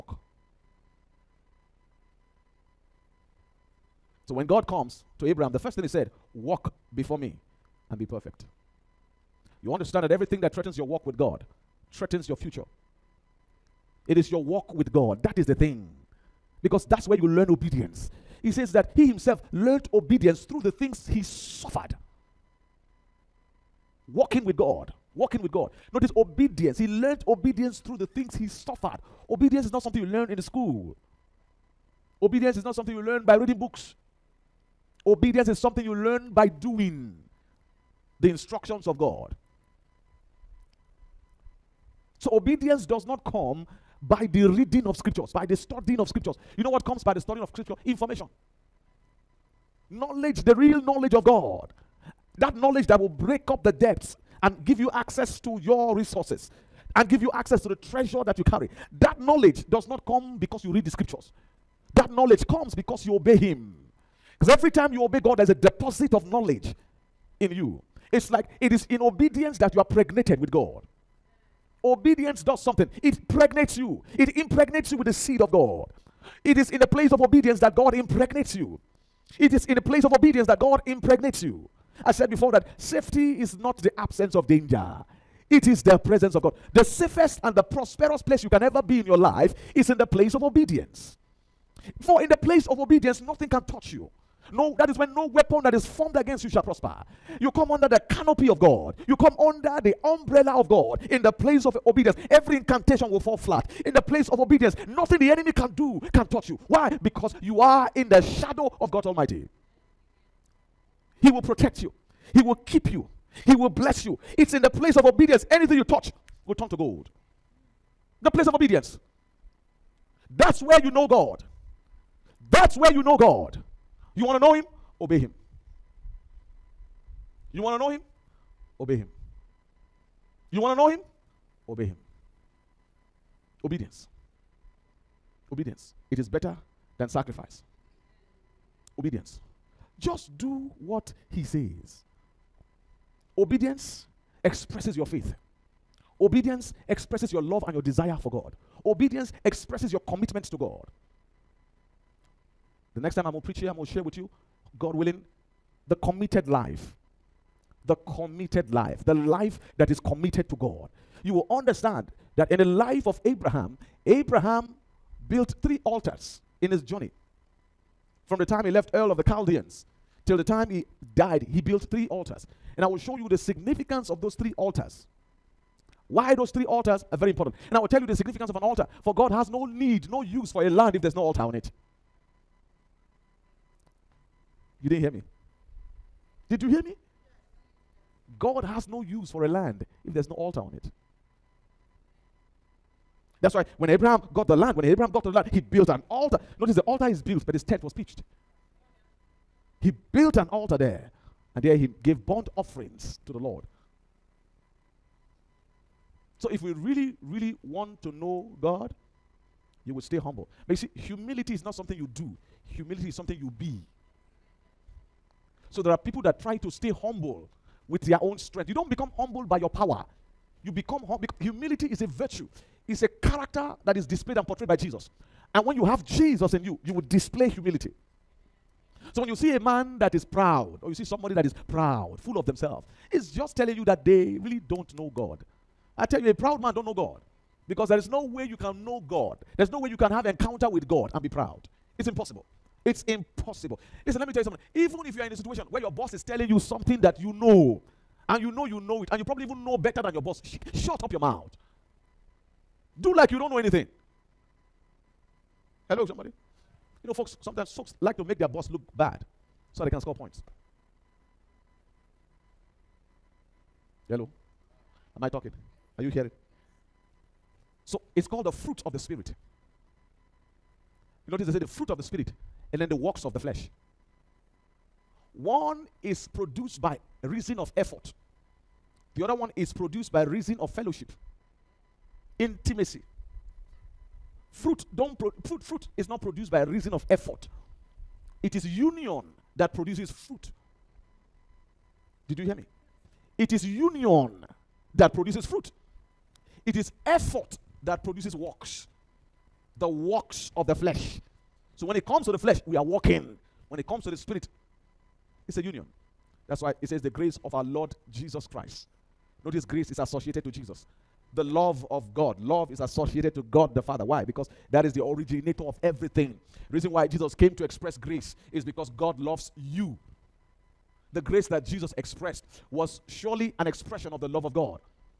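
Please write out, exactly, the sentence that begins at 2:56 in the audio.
Why those three altars are very important.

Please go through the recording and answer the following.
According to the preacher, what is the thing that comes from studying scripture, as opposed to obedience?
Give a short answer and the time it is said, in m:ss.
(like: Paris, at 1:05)
Information, at 0:47.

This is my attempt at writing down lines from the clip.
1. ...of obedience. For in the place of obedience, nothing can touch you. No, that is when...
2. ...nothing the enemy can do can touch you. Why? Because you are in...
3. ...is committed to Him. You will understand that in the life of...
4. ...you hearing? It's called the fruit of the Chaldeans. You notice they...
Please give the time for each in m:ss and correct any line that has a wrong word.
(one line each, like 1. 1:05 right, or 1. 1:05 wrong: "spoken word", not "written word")
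1. 1:30 right
2. 1:44 right
3. 2:39 wrong: "God", not "Him"
4. 4:26 wrong: "Spirit", not "Chaldeans".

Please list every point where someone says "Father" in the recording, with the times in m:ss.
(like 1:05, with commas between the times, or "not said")
5:13.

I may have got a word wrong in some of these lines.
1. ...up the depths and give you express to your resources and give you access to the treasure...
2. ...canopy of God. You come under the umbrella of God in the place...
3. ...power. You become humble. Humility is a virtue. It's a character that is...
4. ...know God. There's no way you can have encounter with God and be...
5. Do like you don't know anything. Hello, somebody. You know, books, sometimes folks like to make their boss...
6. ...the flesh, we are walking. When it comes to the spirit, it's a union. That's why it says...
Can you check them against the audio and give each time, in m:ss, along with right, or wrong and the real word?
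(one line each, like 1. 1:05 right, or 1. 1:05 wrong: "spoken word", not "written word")
1. 0:53 wrong: "access", not "express"
2. 1:38 right
3. 3:39 right
4. 3:58 right
5. 4:13 wrong: "folks", not "books"
6. 5:02 right.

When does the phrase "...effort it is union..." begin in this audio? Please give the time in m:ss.
4:47.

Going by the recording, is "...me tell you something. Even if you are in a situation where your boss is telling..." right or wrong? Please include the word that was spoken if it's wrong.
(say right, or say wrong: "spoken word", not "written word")
right.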